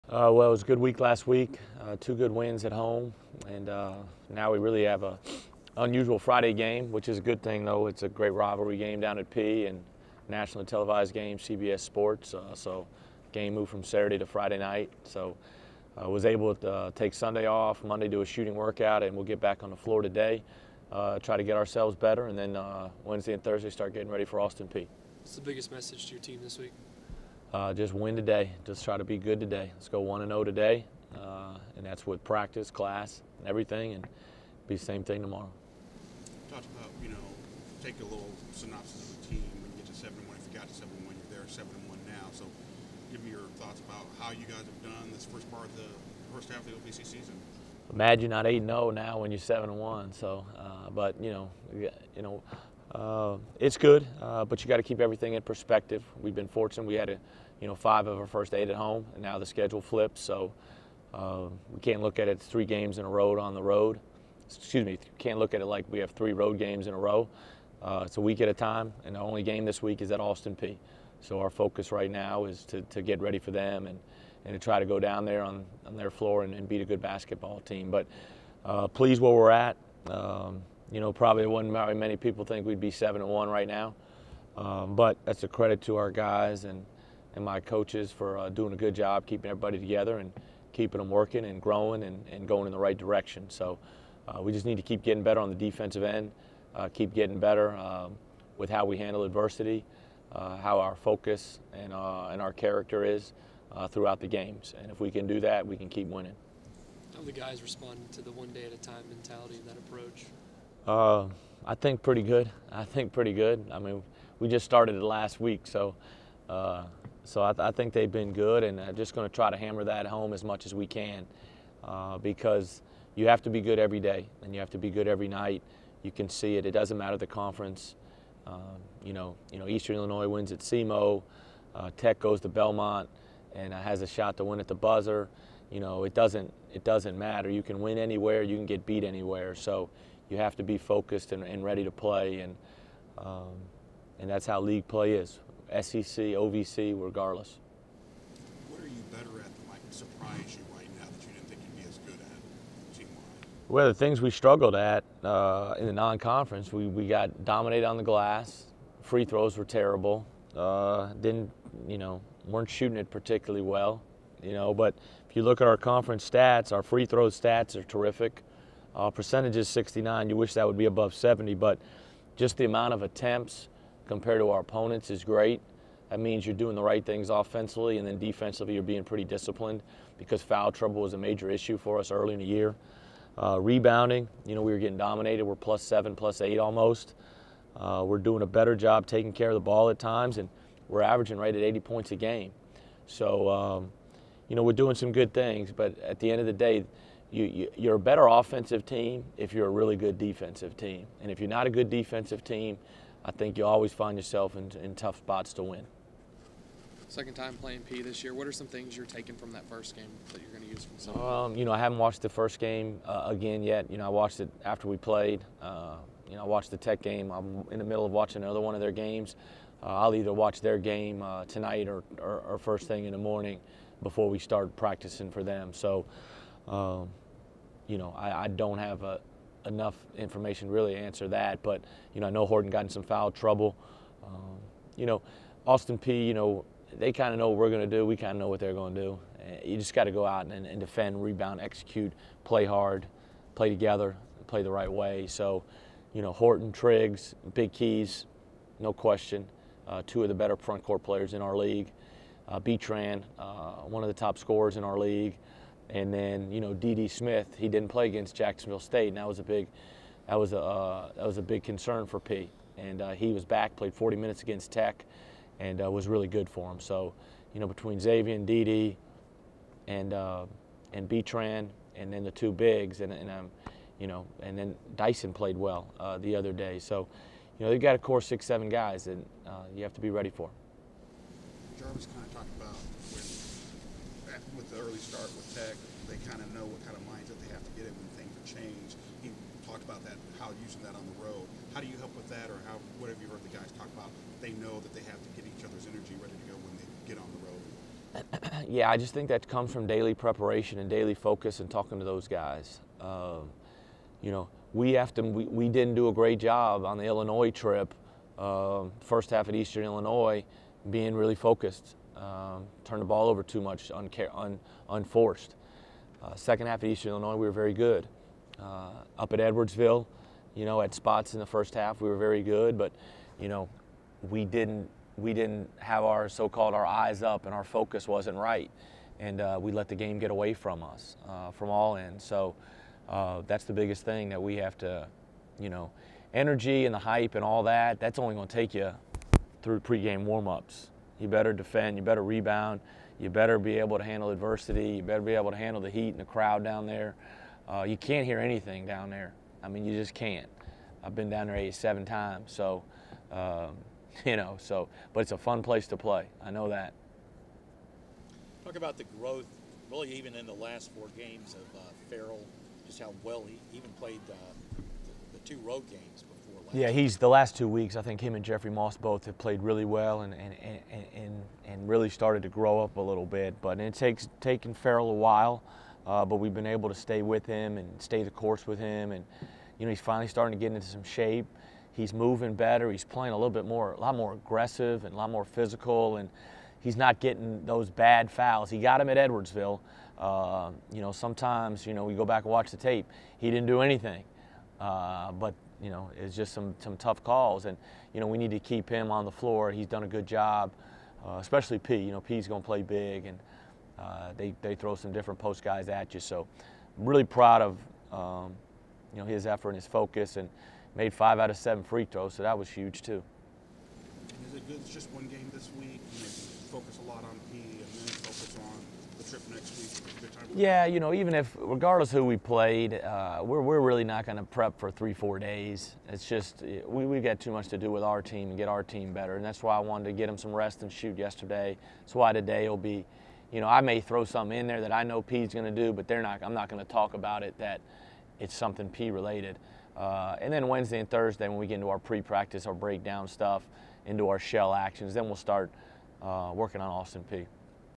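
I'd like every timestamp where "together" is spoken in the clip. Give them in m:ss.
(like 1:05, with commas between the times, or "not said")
1:29, 4:03.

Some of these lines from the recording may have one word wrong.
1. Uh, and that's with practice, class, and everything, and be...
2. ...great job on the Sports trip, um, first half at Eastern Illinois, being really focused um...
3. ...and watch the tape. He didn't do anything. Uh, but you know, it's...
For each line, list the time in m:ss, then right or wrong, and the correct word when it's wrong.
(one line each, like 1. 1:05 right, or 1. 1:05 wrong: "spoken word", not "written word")
1. 0:31 right
2. 5:06 wrong: "Illinois", not "Sports"
3. 6:32 right.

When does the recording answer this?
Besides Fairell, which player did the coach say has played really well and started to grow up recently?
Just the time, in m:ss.
6:08.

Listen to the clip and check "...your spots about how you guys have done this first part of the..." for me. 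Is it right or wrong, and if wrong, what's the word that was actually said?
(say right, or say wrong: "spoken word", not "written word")
wrong: "thoughts", not "spots".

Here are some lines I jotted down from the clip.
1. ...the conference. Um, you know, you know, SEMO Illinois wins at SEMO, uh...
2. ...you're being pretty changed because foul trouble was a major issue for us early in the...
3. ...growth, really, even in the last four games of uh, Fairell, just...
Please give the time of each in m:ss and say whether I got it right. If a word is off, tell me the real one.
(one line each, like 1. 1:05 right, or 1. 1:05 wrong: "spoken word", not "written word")
1. 2:07 wrong: "Eastern", not "SEMO"
2. 2:58 wrong: "disciplined", not "changed"
3. 5:59 right.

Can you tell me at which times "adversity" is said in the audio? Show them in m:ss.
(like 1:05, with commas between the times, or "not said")
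1:39, 5:44.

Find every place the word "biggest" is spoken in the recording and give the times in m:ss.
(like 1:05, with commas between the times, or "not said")
0:25, 5:33.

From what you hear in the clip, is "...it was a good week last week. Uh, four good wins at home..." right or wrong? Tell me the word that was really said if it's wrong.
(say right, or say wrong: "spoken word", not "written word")
wrong: "two", not "four".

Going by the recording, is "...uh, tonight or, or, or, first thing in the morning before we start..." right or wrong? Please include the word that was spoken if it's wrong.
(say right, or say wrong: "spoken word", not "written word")
right.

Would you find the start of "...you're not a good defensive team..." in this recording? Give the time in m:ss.
3:21.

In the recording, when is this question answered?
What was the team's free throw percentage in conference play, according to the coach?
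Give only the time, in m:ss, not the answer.
2:49.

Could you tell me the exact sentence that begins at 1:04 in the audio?
Excuse me, can't look at it like we have three road games in a row.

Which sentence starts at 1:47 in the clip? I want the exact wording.
How the guys responded to the one day at a time mentality and that approach?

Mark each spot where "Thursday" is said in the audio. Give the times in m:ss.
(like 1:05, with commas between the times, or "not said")
0:23, 7:21.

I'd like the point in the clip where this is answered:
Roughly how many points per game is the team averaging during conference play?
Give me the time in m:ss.
3:11.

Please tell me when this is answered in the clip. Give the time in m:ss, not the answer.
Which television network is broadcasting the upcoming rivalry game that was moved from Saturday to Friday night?
0:11.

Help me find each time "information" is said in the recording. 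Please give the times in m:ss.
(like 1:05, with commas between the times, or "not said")
3:50.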